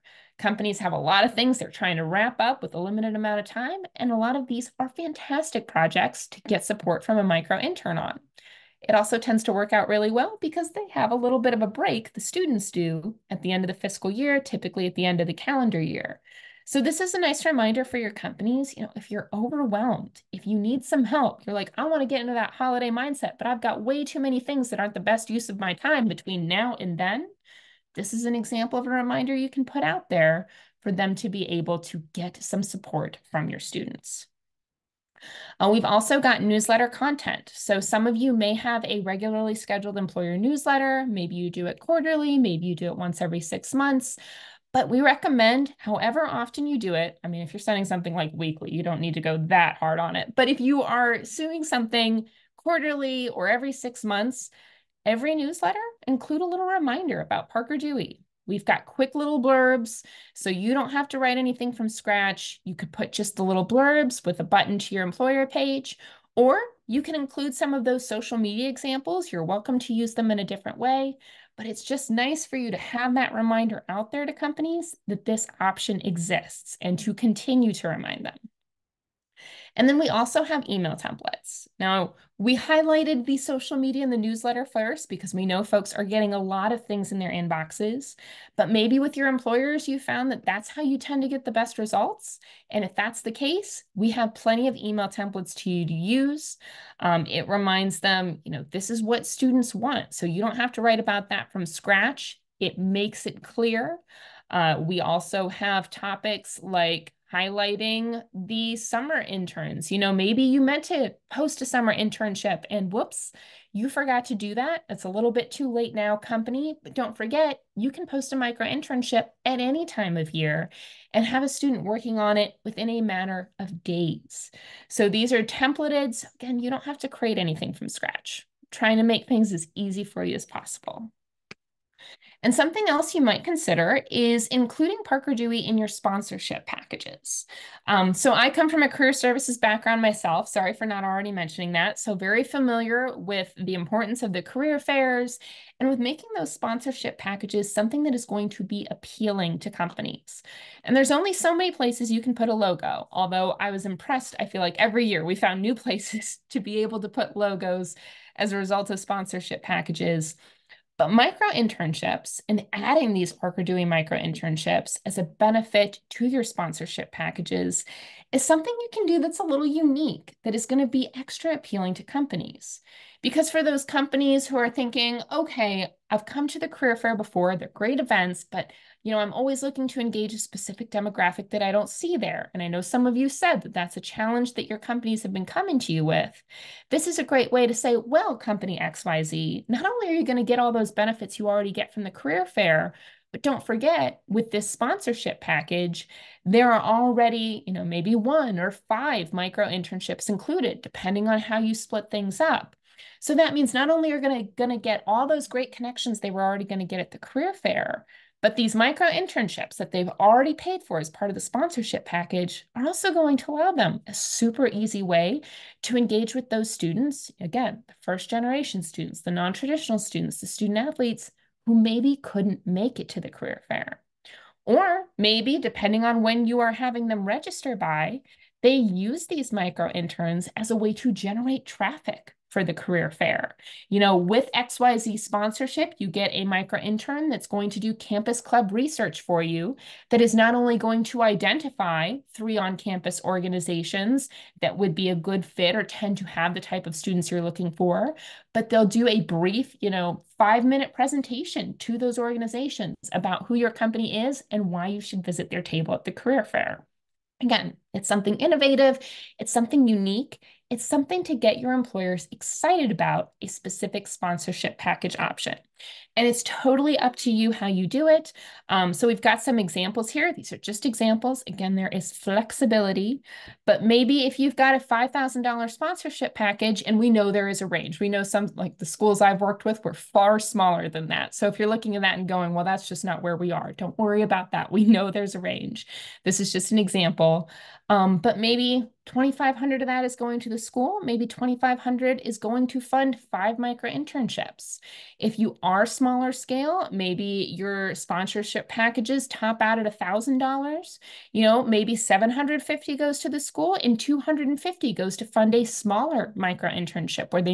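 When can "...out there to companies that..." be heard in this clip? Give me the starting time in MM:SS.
01:13.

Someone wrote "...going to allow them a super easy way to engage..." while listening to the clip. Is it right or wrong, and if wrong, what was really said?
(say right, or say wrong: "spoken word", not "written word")
right.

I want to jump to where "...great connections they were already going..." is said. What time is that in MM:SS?
03:25.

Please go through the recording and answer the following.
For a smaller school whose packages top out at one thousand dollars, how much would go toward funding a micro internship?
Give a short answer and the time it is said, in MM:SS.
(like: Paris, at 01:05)
$250, at 05:03.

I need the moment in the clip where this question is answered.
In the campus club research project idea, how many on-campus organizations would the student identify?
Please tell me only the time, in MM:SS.
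04:02.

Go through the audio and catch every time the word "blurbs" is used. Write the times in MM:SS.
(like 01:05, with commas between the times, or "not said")
00:59, 01:03.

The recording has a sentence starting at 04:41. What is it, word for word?
So if you're looking at that and going, well, that's just not where we are.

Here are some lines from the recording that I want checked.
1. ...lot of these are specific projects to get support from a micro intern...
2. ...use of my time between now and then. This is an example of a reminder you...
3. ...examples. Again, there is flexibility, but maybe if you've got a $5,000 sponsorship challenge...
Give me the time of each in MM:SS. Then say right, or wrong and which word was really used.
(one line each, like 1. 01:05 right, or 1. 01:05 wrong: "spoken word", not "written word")
1. 00:04 wrong: "fantastic", not "specific"
2. 00:25 right
3. 04:30 wrong: "package", not "challenge".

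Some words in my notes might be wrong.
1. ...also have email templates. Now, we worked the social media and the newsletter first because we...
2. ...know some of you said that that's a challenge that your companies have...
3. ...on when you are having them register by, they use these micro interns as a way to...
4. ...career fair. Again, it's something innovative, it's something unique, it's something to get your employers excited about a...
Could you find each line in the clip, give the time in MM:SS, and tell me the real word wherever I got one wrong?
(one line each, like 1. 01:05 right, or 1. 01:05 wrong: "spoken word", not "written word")
1. 01:20 wrong: "highlighted", not "worked"
2. 03:02 right
3. 03:46 right
4. 04:16 right.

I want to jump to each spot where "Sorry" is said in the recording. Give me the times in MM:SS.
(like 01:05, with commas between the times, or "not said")
02:20.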